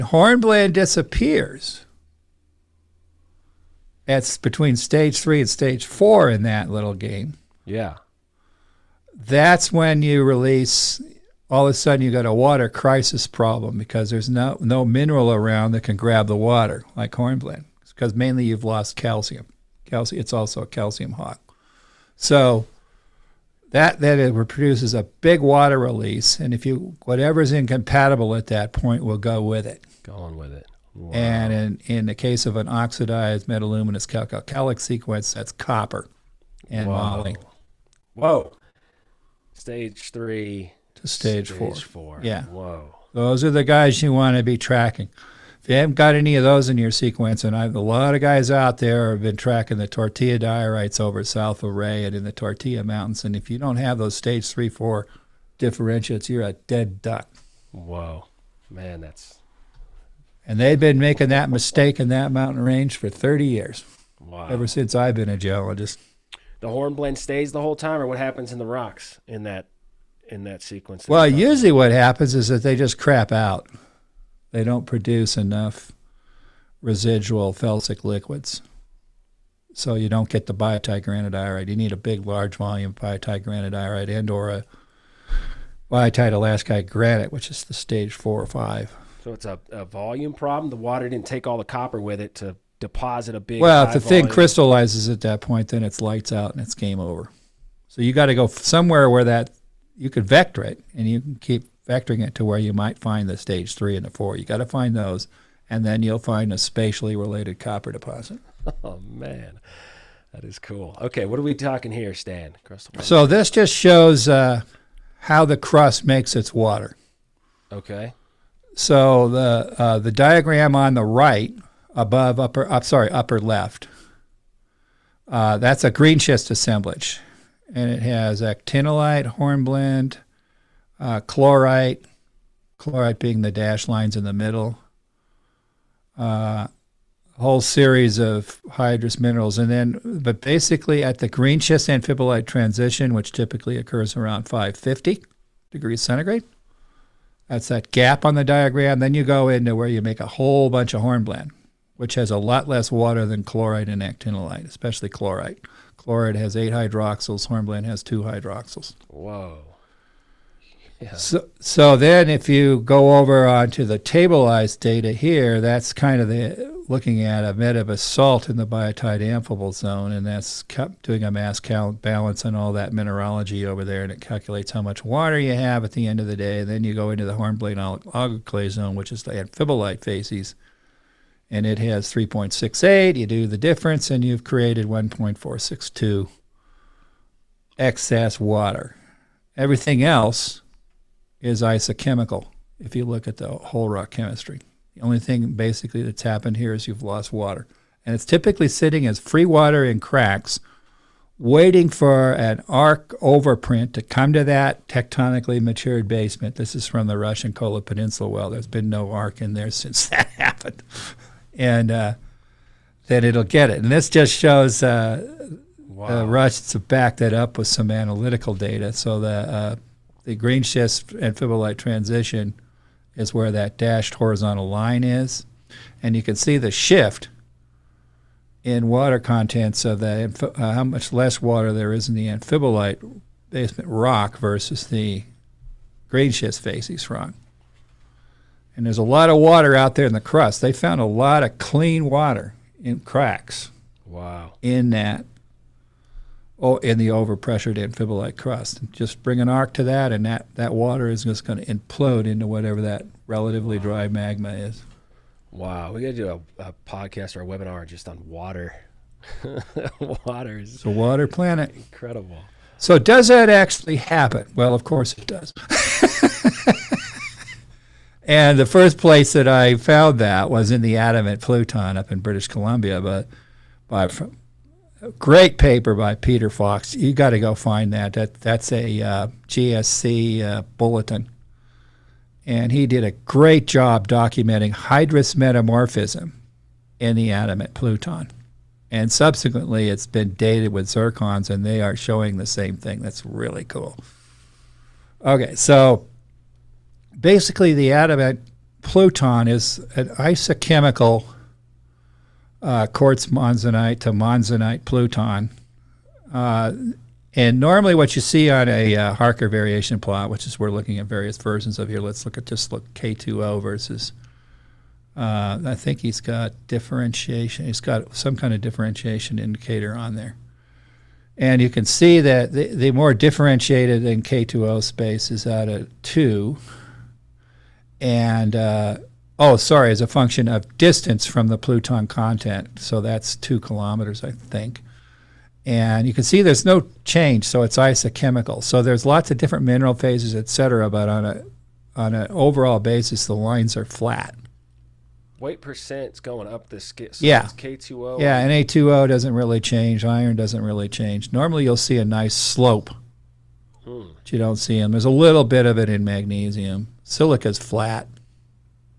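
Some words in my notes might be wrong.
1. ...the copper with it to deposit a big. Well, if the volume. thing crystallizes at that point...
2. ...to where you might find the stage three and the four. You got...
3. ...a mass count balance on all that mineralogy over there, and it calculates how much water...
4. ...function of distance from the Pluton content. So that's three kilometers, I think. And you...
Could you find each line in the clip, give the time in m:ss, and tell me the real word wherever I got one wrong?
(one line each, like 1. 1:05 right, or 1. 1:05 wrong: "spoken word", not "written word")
1. 1:31 right
2. 1:42 right
3. 2:51 right
4. 5:30 wrong: "two", not "three".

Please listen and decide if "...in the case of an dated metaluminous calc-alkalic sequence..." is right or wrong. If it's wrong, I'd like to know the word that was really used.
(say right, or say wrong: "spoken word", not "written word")
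wrong: "oxidized", not "dated".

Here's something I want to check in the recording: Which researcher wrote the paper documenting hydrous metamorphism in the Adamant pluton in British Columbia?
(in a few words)
Peter Fox.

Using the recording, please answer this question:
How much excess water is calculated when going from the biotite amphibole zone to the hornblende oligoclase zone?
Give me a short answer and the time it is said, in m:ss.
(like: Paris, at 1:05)
1.462, at 3:04.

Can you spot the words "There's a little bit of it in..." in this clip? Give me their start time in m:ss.
5:54.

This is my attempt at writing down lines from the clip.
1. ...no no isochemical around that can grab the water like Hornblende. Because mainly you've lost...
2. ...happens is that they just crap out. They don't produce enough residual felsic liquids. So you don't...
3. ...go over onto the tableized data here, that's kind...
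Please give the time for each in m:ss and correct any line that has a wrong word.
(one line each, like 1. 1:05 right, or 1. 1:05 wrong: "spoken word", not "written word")
1. 0:14 wrong: "mineral", not "isochemical"
2. 1:11 right
3. 2:42 right.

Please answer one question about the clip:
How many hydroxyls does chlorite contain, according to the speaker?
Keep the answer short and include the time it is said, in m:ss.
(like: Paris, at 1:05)
8, at 2:36.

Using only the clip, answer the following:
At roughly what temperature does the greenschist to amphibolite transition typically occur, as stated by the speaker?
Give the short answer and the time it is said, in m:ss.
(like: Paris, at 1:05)
550 degrees centigrade, at 2:24.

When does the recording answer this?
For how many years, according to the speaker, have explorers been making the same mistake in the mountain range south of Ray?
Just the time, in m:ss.
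1:03.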